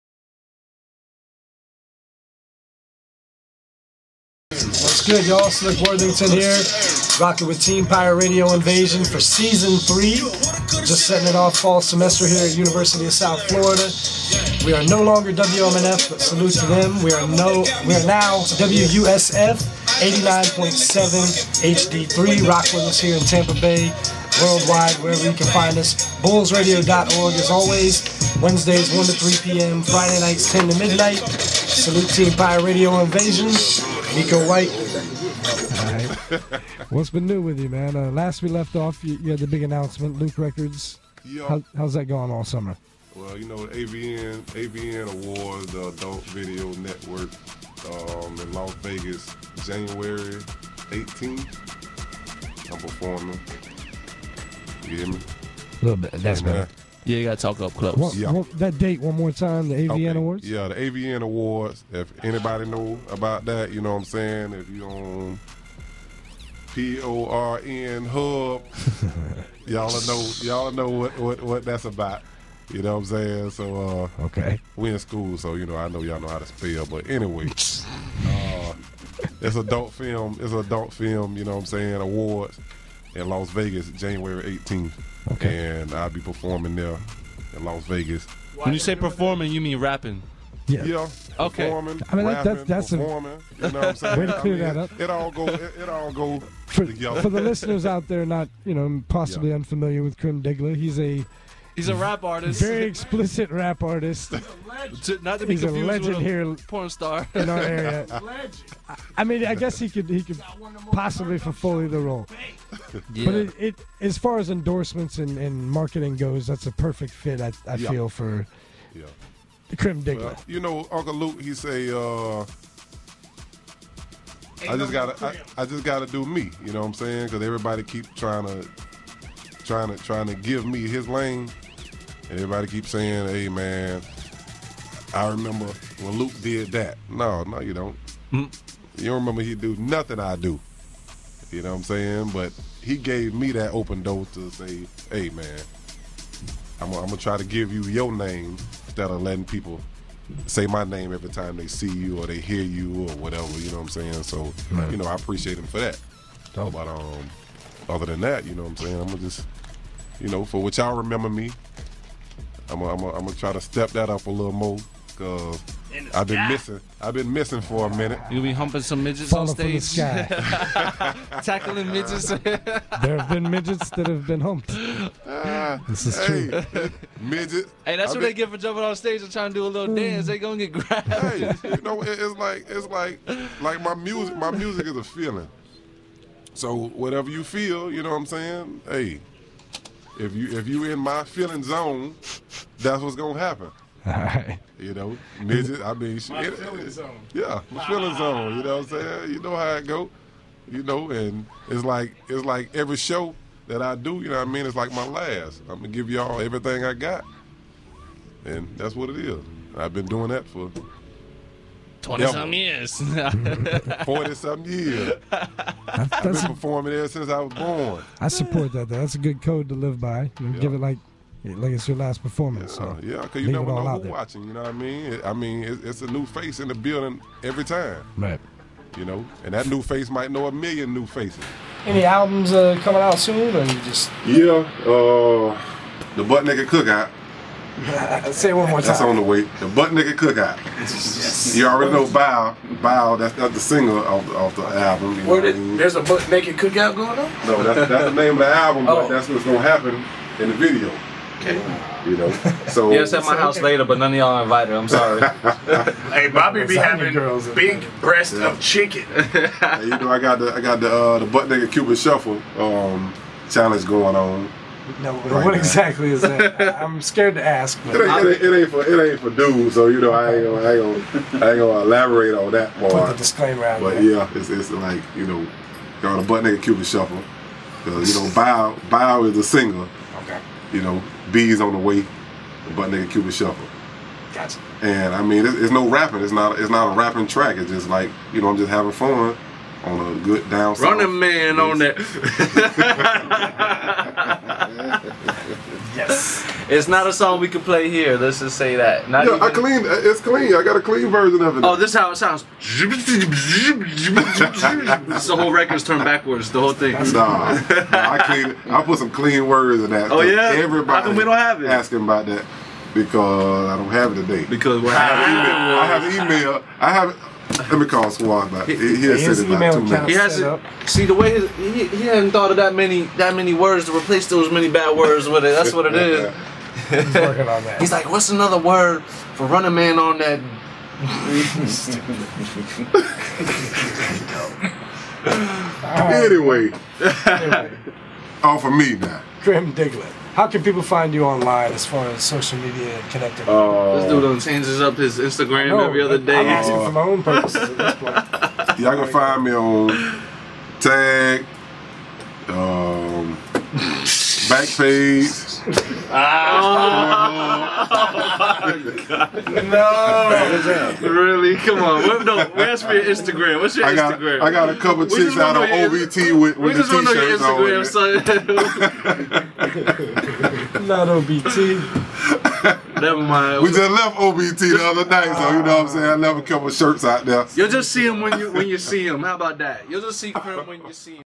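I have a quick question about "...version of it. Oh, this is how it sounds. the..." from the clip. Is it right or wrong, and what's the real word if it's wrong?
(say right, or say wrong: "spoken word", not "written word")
right.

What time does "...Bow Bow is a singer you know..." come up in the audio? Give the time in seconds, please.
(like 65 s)
278 s.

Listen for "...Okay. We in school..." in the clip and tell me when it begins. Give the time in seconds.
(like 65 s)
74 s.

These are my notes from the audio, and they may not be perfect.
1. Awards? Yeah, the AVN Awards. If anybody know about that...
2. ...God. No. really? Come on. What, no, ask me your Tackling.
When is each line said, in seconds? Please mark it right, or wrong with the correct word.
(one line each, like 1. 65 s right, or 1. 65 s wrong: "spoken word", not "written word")
1. 60 s right
2. 359 s wrong: "Instagram", not "Tackling".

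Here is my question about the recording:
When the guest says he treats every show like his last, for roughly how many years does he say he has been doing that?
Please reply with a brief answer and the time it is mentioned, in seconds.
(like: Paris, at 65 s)
20-some years, at 212 s.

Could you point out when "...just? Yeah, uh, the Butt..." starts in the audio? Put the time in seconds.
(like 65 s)
233 s.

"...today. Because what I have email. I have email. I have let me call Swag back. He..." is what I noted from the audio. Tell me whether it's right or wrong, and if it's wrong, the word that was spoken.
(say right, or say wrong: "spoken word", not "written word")
right.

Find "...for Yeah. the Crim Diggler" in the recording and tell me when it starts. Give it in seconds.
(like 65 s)
118 s.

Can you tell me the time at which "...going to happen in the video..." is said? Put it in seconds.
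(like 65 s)
249 s.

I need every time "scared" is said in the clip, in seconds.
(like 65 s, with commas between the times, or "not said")
267 s.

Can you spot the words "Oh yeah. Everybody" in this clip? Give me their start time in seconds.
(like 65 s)
310 s.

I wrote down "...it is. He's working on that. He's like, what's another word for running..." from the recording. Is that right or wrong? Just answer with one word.
right.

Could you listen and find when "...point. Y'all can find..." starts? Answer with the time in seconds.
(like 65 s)
347 s.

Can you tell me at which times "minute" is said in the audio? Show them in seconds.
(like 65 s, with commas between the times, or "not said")
167 s, 319 s.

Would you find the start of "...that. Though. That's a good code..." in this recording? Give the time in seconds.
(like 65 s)
218 s.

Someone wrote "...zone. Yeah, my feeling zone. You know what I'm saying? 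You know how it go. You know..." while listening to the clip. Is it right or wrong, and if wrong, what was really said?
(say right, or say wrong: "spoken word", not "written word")
right.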